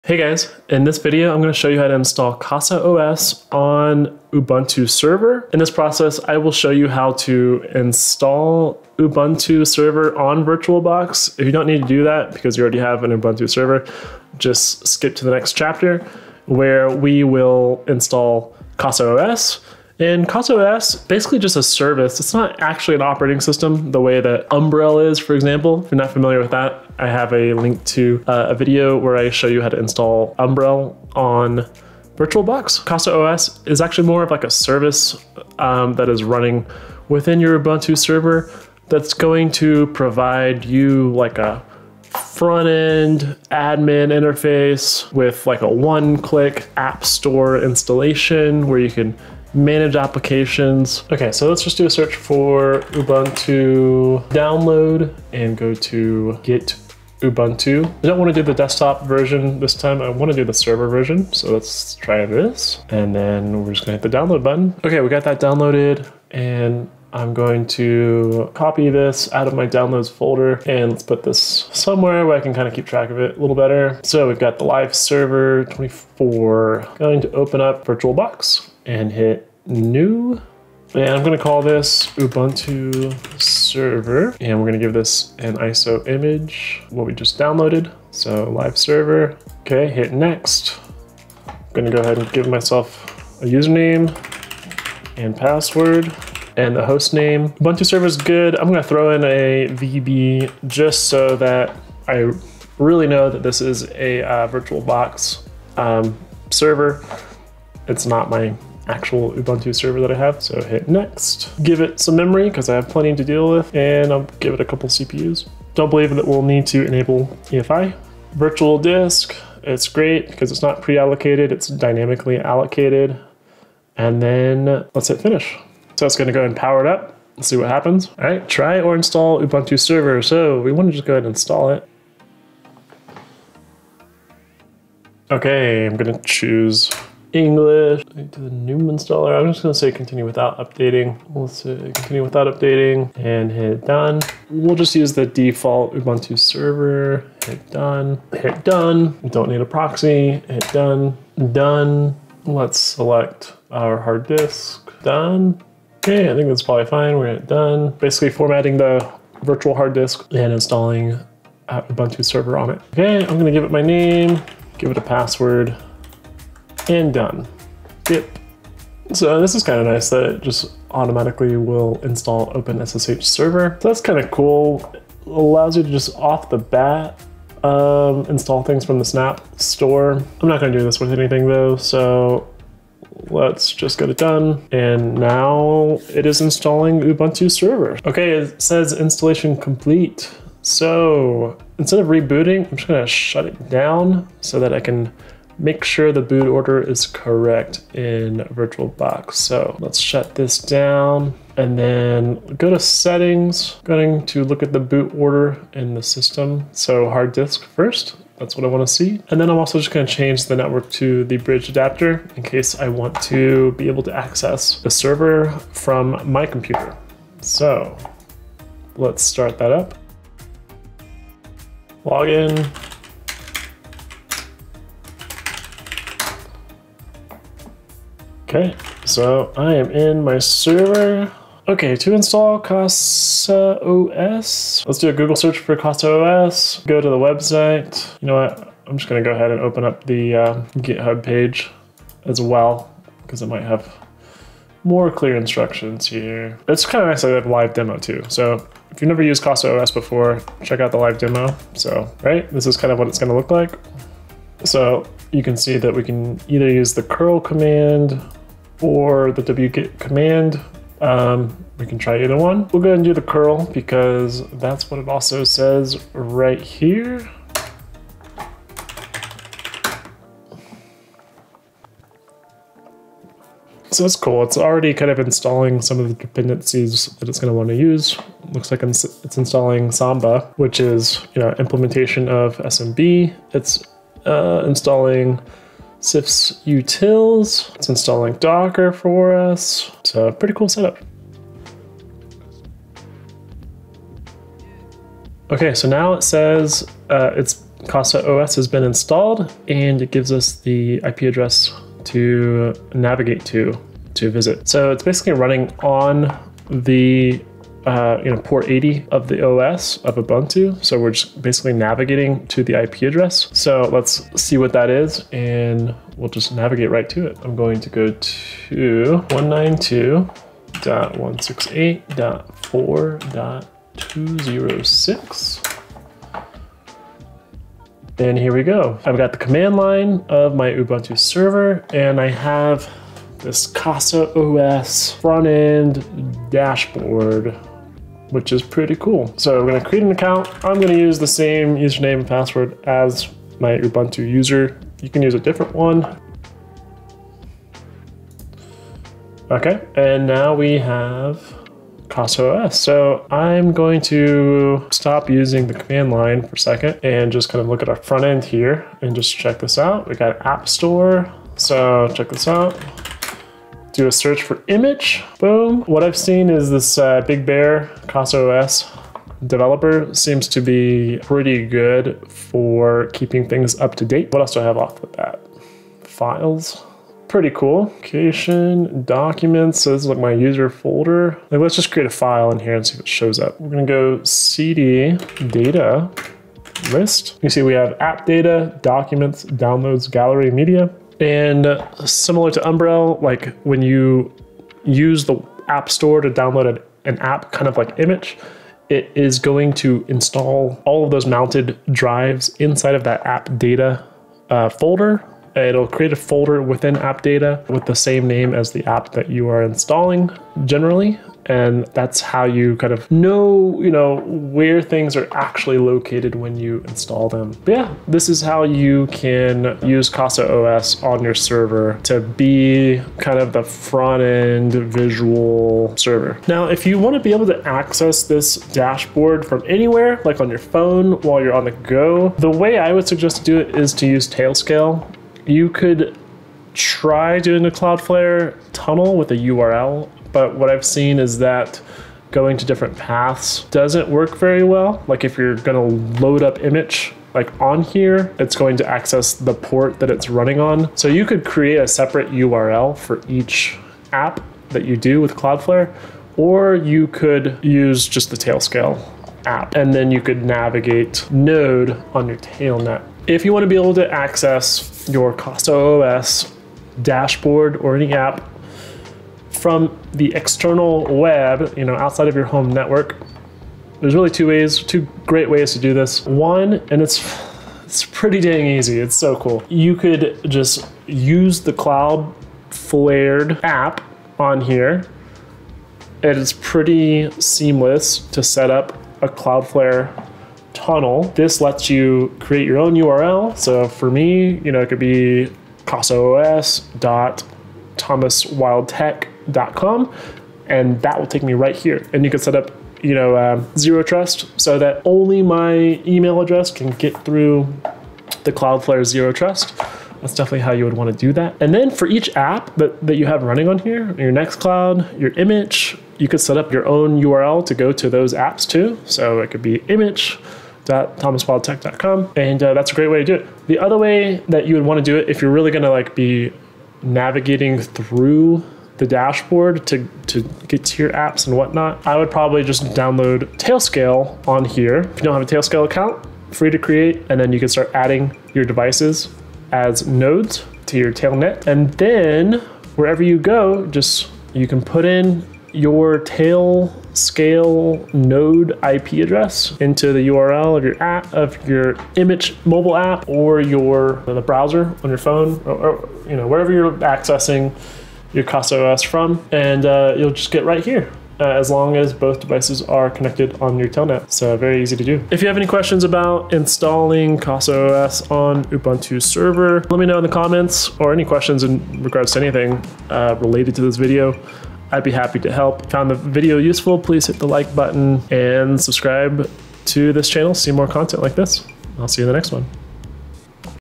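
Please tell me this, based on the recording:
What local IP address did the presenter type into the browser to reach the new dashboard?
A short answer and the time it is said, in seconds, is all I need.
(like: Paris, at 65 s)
192.168.4.206, at 319 s.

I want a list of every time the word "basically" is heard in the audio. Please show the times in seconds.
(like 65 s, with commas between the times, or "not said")
20 s, 157 s, 305 s, 311 s.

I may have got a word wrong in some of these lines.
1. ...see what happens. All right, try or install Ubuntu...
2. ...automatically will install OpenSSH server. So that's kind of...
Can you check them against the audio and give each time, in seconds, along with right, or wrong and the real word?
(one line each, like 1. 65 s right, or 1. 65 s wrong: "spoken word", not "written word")
1. 127 s right
2. 170 s right.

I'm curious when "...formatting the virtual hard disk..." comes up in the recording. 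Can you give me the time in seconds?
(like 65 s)
158 s.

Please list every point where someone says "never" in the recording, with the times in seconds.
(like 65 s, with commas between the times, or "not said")
249 s.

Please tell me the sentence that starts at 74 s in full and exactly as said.
So we've got the live server 24.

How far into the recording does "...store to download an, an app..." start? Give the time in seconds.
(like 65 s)
395 s.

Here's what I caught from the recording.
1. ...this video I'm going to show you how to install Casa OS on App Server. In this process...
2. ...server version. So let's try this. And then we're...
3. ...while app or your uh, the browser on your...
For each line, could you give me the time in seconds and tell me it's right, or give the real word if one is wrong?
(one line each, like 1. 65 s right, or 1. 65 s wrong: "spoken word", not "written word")
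1. 0 s wrong: "Ubuntu", not "App"
2. 60 s right
3. 552 s wrong: "mobile", not "while".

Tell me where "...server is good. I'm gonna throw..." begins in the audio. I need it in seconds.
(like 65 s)
97 s.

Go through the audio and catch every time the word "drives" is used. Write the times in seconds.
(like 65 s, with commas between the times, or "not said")
401 s.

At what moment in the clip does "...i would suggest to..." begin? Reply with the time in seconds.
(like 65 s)
432 s.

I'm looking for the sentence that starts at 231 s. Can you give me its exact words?
Okay, to install Casa OS, let's do a Google search for Casa OS, go to the website.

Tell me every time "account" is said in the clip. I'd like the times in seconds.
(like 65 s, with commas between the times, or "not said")
340 s, 535 s.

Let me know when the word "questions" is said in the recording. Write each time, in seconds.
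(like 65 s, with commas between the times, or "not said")
565 s, 571 s.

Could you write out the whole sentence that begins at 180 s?
I'm not gonna do this with anything though, so let's just get it done.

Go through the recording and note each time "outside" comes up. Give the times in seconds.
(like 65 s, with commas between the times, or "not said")
471 s.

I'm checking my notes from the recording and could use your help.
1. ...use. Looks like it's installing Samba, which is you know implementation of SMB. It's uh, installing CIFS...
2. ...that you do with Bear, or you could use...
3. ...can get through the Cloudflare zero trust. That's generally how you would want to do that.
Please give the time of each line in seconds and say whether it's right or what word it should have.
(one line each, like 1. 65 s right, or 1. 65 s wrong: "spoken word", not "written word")
1. 277 s right
2. 454 s wrong: "Cloudflare", not "Bear"
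3. 506 s wrong: "definitely", not "generally".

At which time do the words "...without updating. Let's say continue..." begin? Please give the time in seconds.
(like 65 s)
140 s.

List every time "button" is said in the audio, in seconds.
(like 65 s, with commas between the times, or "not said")
64 s, 577 s.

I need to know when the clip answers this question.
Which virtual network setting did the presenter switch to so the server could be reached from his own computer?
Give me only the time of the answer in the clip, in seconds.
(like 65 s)
211 s.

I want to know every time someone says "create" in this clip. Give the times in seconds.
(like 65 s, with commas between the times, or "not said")
339 s, 381 s, 405 s, 451 s, 492 s, 536 s.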